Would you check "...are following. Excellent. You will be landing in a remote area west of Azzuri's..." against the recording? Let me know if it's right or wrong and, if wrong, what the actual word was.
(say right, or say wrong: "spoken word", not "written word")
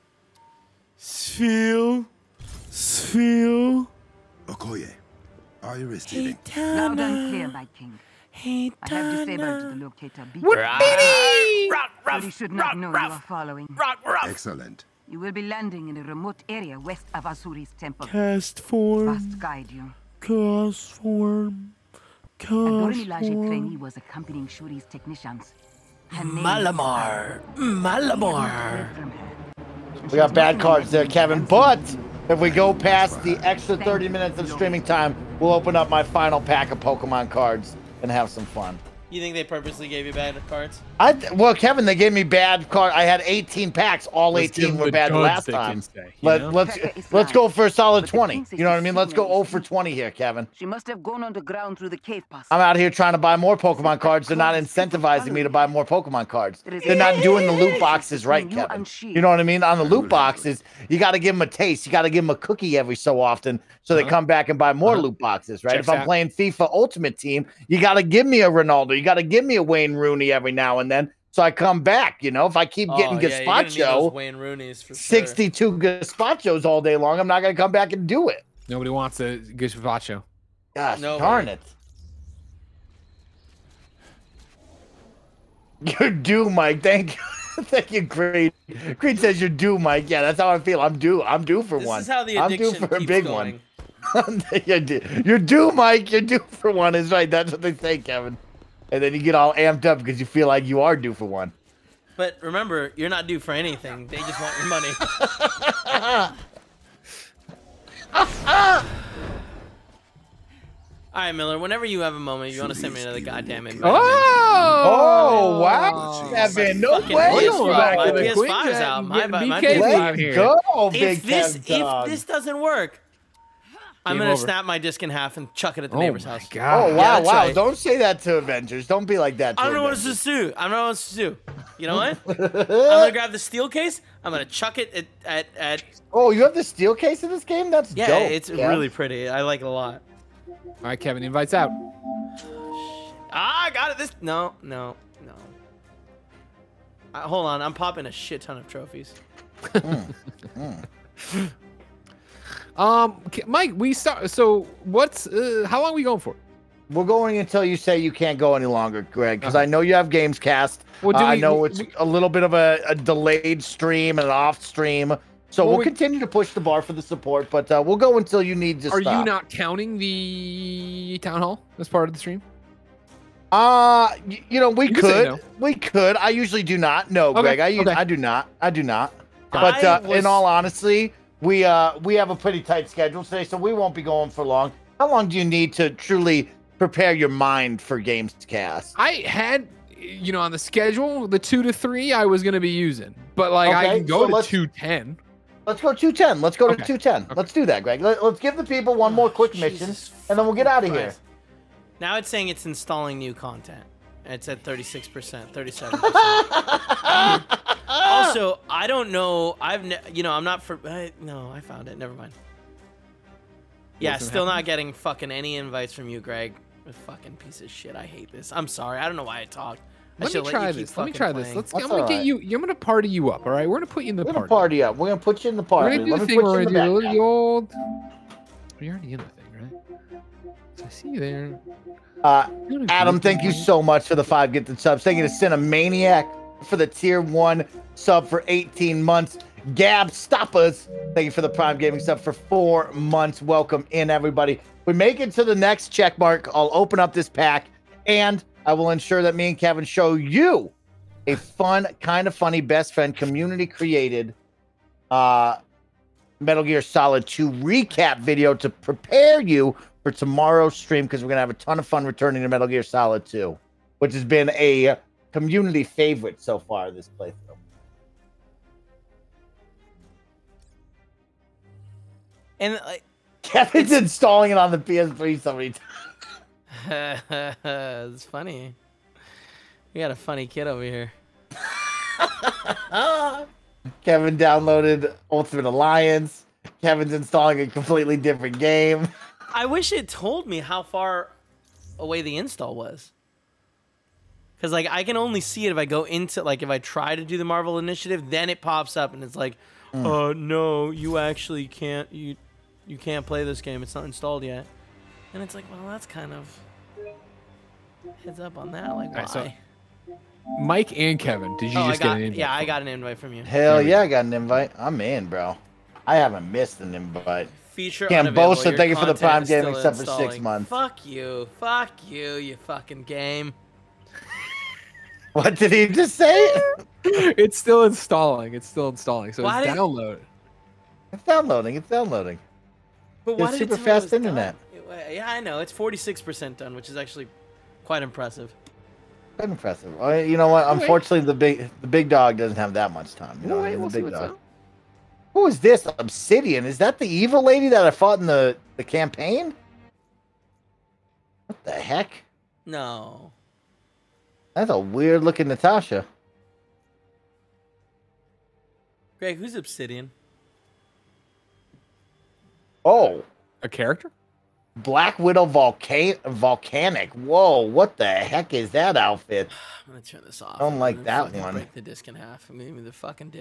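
right.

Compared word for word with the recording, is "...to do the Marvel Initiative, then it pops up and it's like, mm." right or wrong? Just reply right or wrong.
right.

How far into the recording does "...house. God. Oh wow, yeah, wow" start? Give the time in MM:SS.
02:06.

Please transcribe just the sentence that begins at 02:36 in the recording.
We're going until you say you can't go any longer, Greg, because uh-huh.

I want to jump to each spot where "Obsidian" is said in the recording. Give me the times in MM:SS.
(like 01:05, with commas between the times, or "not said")
05:45, 05:59.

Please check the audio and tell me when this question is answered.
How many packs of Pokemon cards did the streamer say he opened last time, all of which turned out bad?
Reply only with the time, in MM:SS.
00:42.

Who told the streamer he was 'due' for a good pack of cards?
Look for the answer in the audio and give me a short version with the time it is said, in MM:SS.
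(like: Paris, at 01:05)
Creed, at 01:28.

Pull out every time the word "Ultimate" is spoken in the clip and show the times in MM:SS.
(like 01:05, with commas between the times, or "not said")
01:06, 04:45.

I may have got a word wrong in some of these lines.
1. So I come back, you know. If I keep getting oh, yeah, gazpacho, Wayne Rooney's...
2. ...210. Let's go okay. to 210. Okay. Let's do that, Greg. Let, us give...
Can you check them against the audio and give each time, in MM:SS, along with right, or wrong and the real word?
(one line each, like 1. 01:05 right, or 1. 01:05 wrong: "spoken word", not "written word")
1. 01:11 right
2. 03:15 right.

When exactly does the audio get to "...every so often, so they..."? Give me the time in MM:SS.
01:02.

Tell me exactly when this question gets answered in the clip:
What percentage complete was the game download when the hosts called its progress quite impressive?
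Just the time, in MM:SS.
05:35.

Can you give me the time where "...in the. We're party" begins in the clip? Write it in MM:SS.
03:44.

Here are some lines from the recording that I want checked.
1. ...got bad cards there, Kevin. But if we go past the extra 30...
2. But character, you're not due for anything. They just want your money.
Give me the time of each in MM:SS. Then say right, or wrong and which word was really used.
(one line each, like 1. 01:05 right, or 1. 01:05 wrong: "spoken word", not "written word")
1. 00:30 right
2. 01:42 wrong: "remember", not "character".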